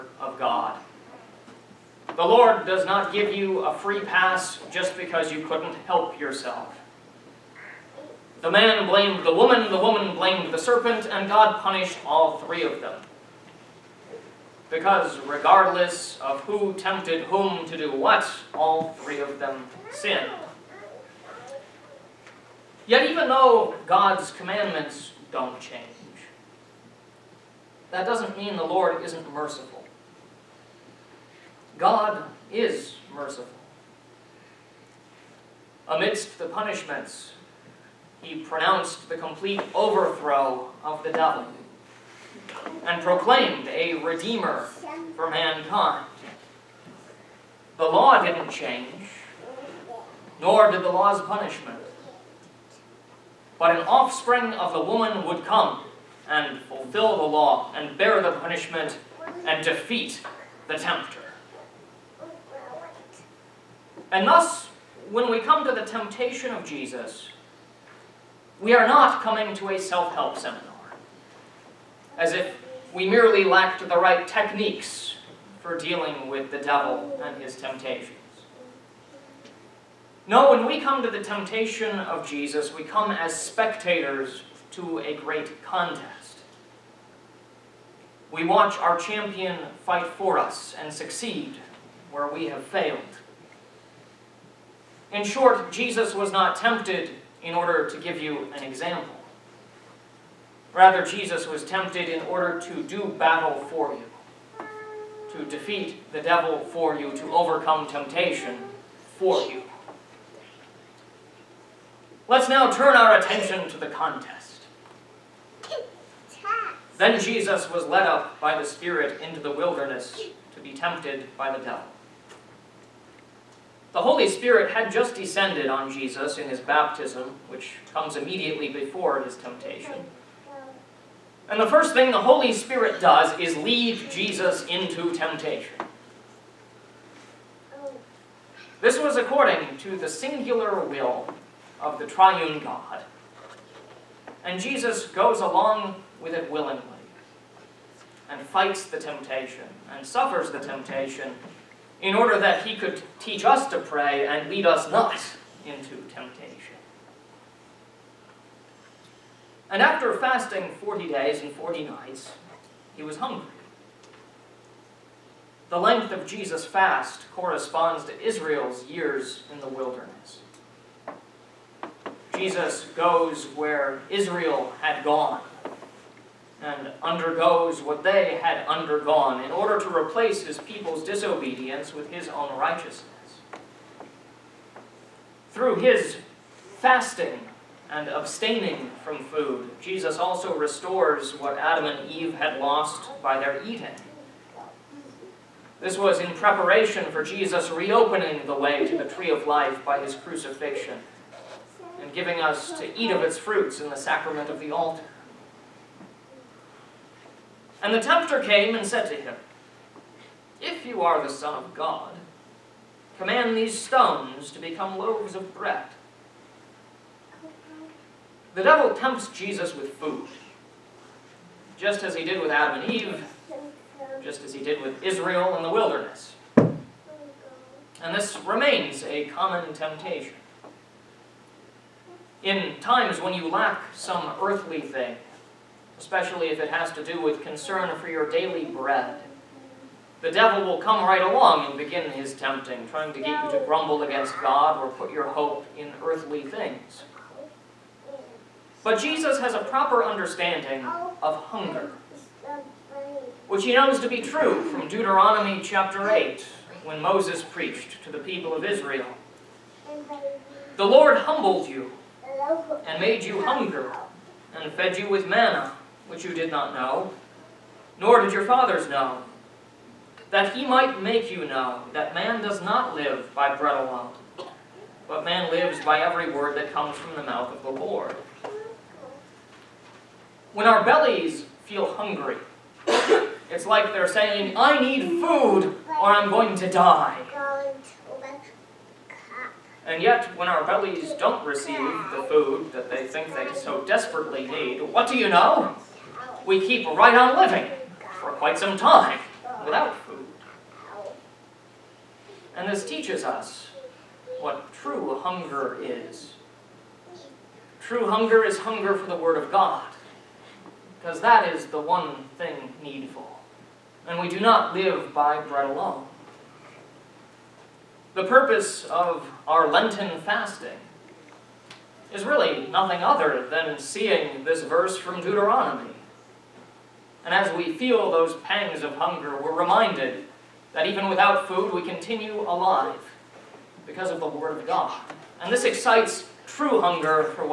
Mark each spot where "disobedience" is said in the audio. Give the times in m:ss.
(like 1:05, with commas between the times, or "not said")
3:01.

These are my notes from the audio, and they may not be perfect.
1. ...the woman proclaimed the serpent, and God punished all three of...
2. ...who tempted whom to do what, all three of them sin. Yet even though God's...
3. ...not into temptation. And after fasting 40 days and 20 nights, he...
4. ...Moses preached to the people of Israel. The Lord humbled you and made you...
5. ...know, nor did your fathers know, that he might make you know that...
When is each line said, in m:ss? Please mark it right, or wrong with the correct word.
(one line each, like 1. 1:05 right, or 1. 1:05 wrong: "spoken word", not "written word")
1. 0:09 wrong: "blamed", not "proclaimed"
2. 0:16 right
3. 2:34 wrong: "40", not "20"
4. 4:17 right
5. 4:26 right.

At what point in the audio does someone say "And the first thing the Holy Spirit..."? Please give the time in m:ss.
2:11.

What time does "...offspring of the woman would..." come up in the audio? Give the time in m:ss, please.
0:53.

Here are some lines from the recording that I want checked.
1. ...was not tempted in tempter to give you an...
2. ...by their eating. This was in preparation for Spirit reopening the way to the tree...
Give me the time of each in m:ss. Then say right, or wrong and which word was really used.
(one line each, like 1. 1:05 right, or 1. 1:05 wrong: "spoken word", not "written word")
1. 1:36 wrong: "order", not "tempter"
2. 3:13 wrong: "Jesus", not "Spirit".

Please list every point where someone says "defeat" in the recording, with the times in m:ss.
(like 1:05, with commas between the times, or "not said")
0:59, 1:45.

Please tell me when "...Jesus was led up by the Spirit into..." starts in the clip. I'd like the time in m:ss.
1:57.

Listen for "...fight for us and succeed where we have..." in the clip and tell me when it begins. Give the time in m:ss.
1:29.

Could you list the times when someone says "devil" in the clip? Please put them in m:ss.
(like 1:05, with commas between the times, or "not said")
0:41, 1:16, 1:46, 2:01, 3:38, 4:00.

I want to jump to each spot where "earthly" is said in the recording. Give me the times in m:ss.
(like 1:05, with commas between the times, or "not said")
3:54, 4:06.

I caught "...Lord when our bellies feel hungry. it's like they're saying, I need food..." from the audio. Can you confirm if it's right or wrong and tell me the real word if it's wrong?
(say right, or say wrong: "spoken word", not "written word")
right.